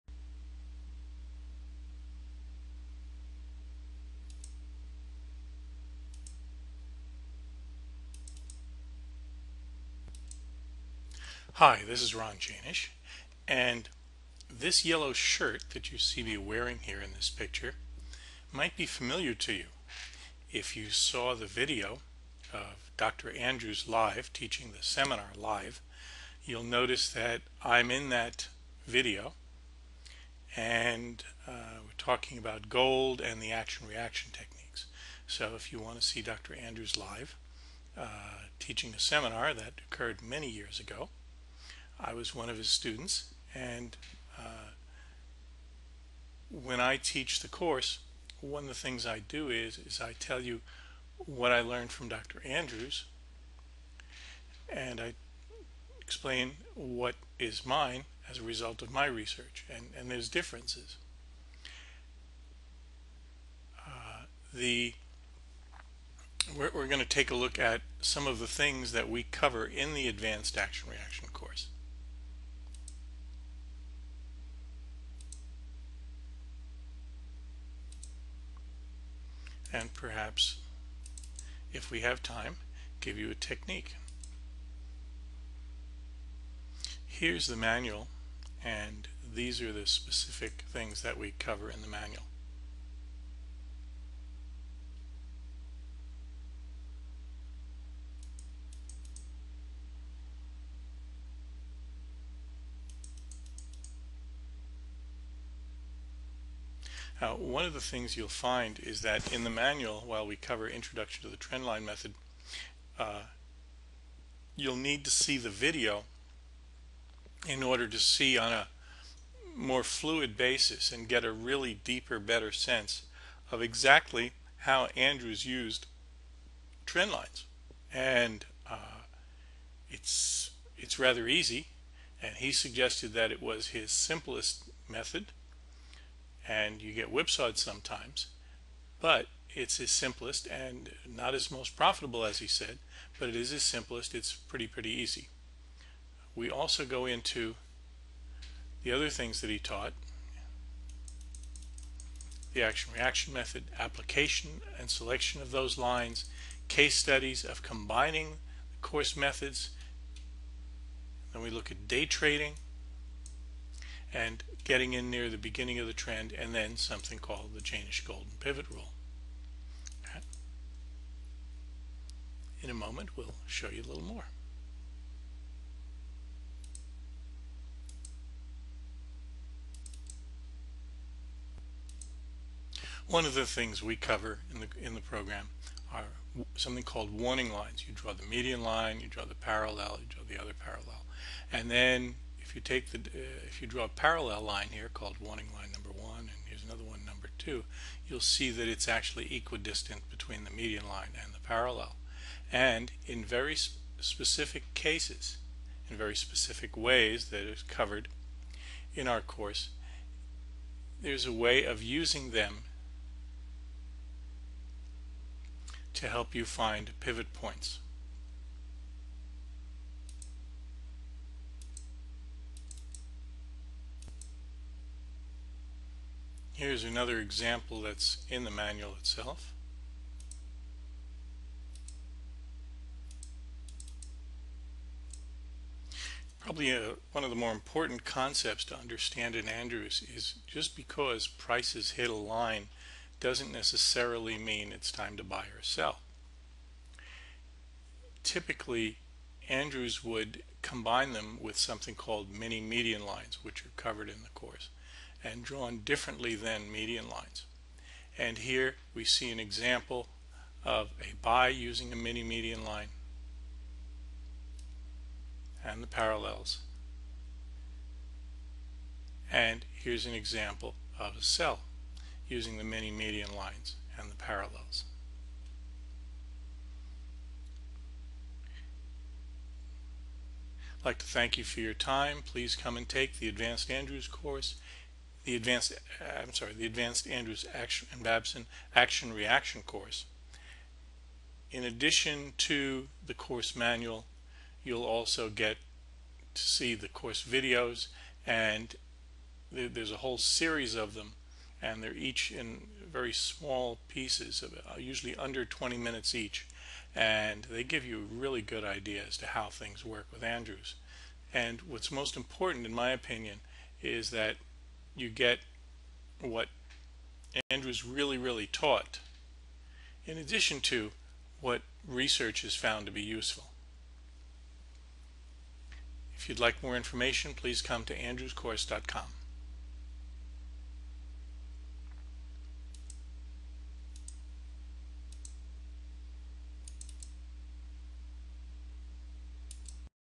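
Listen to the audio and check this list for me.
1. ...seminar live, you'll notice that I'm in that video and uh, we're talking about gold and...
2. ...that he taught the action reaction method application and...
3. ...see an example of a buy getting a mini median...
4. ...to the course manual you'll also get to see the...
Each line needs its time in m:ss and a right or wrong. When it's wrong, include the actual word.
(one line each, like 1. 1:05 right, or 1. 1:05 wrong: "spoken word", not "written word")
1. 0:24 right
2. 2:29 right
3. 4:19 wrong: "using", not "getting"
4. 4:52 right.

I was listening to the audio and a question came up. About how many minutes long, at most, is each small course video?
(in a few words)
20 minutes.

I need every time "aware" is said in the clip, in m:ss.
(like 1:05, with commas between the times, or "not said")
not said.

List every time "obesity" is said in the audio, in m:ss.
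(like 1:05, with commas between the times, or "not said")
not said.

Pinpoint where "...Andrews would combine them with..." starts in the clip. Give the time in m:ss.
4:09.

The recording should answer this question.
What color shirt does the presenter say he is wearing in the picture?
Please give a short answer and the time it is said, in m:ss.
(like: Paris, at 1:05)
Yellow, at 0:14.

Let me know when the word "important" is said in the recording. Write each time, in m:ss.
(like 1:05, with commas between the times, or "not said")
3:57, 5:12.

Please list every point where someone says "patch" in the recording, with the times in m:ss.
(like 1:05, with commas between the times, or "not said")
not said.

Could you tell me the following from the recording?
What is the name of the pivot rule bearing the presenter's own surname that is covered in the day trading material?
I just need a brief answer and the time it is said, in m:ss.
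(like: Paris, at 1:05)
Jaenisch Golden Pivot Rule, at 2:47.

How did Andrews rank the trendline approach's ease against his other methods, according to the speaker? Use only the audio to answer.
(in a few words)
His simplest method.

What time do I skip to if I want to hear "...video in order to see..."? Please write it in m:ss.
1:55.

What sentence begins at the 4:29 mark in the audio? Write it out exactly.
And here's an example of a sell using the mini median lines and the parallels.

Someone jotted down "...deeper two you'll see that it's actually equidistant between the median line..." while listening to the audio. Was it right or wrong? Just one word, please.
wrong.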